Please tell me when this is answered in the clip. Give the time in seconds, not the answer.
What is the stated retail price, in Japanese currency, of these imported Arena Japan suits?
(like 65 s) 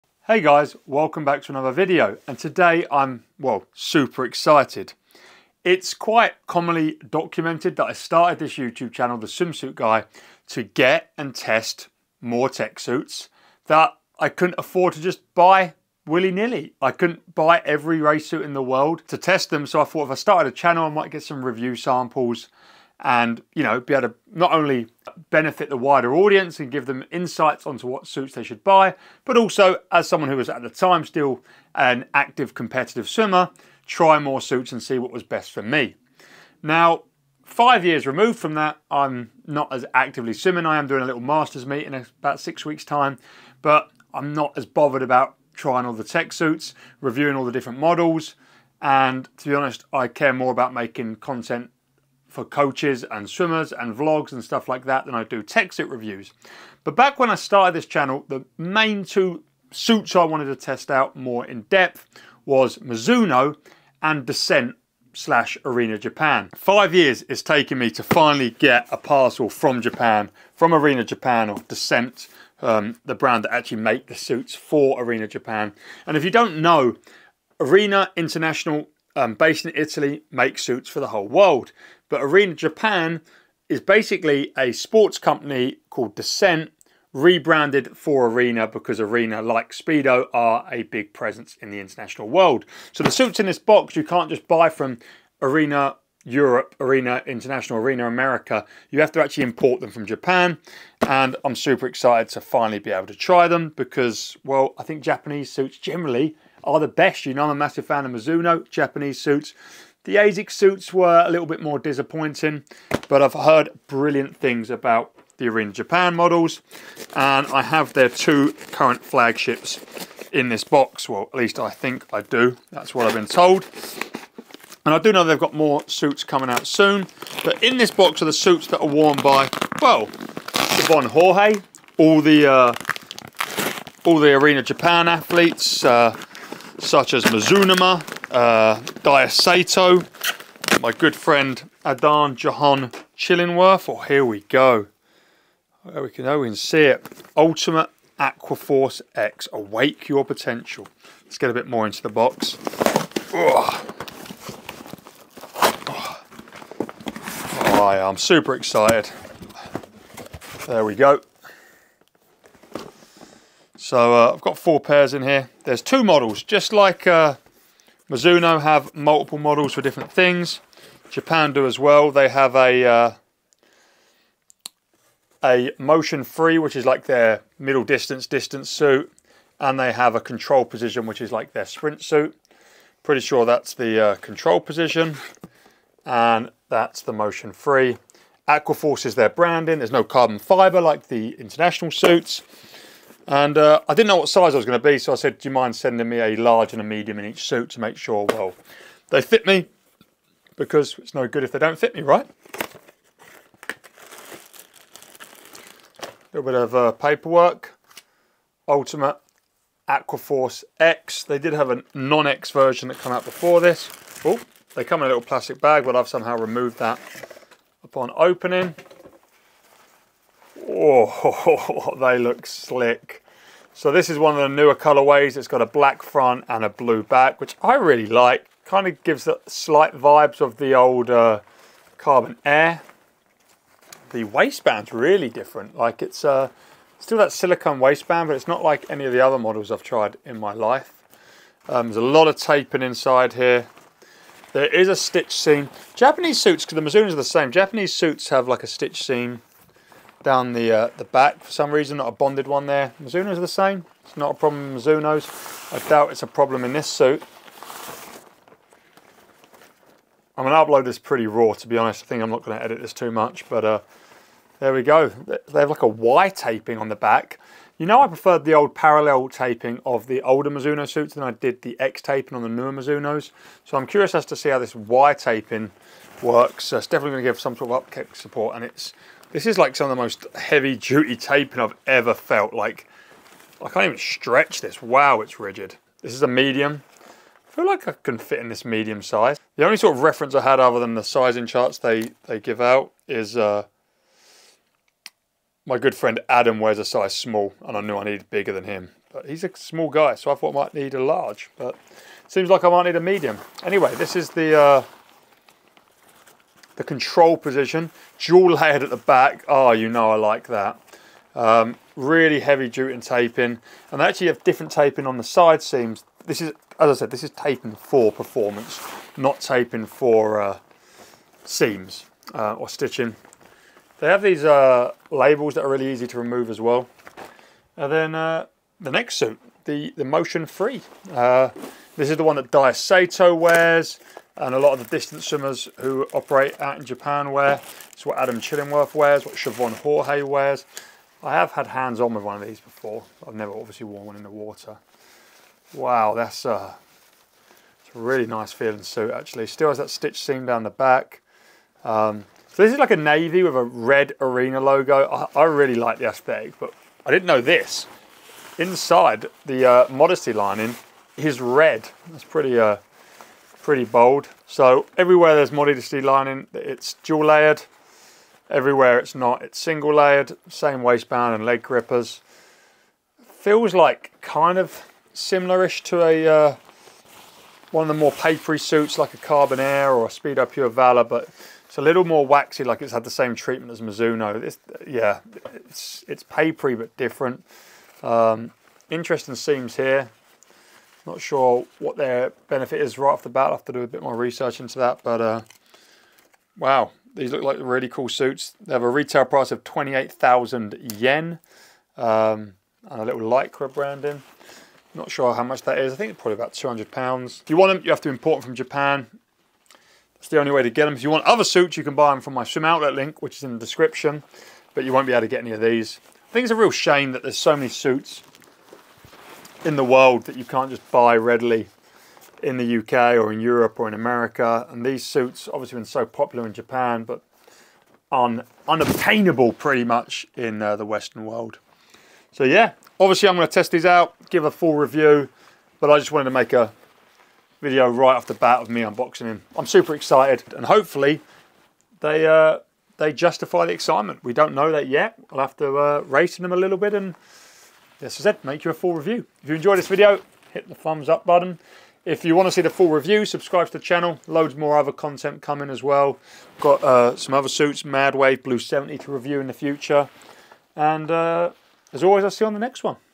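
399 s.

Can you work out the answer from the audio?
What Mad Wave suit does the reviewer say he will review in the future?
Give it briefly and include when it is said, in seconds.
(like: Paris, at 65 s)
Blue 70, at 457 s.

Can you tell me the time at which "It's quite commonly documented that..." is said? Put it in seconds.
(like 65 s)
5 s.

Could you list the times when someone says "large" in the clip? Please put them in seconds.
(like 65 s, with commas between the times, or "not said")
196 s, 301 s.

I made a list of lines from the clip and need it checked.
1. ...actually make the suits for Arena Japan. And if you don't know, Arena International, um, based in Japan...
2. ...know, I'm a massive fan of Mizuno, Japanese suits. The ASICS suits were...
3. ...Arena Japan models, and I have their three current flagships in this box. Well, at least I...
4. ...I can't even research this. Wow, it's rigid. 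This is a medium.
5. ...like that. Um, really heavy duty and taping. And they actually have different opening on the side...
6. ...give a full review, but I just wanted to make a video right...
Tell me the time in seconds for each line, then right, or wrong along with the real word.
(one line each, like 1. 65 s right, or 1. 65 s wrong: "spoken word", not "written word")
1. 73 s wrong: "Italy", not "Japan"
2. 107 s right
3. 115 s wrong: "two", not "three"
4. 283 s wrong: "stretch", not "research"
5. 310 s wrong: "taping", not "opening"
6. 434 s right.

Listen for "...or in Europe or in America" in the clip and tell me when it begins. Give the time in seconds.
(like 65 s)
423 s.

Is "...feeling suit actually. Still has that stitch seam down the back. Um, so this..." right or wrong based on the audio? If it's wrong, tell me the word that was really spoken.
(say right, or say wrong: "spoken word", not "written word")
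right.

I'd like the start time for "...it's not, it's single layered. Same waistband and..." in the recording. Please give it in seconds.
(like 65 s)
368 s.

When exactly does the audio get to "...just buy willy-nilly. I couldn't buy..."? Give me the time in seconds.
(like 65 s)
15 s.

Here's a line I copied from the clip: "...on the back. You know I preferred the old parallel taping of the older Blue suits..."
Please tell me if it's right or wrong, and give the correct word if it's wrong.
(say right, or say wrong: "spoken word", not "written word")
wrong: "Mizuno", not "Blue".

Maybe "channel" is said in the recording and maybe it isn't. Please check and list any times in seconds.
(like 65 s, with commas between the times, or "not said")
8 s, 20 s, 57 s, 453 s.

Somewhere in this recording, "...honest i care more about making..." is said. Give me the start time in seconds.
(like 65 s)
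49 s.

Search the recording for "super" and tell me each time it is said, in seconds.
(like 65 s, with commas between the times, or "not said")
3 s, 101 s, 158 s, 439 s.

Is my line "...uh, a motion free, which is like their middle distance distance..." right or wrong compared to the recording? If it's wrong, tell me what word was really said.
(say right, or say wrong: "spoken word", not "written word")
right.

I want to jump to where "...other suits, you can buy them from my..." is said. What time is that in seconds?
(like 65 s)
411 s.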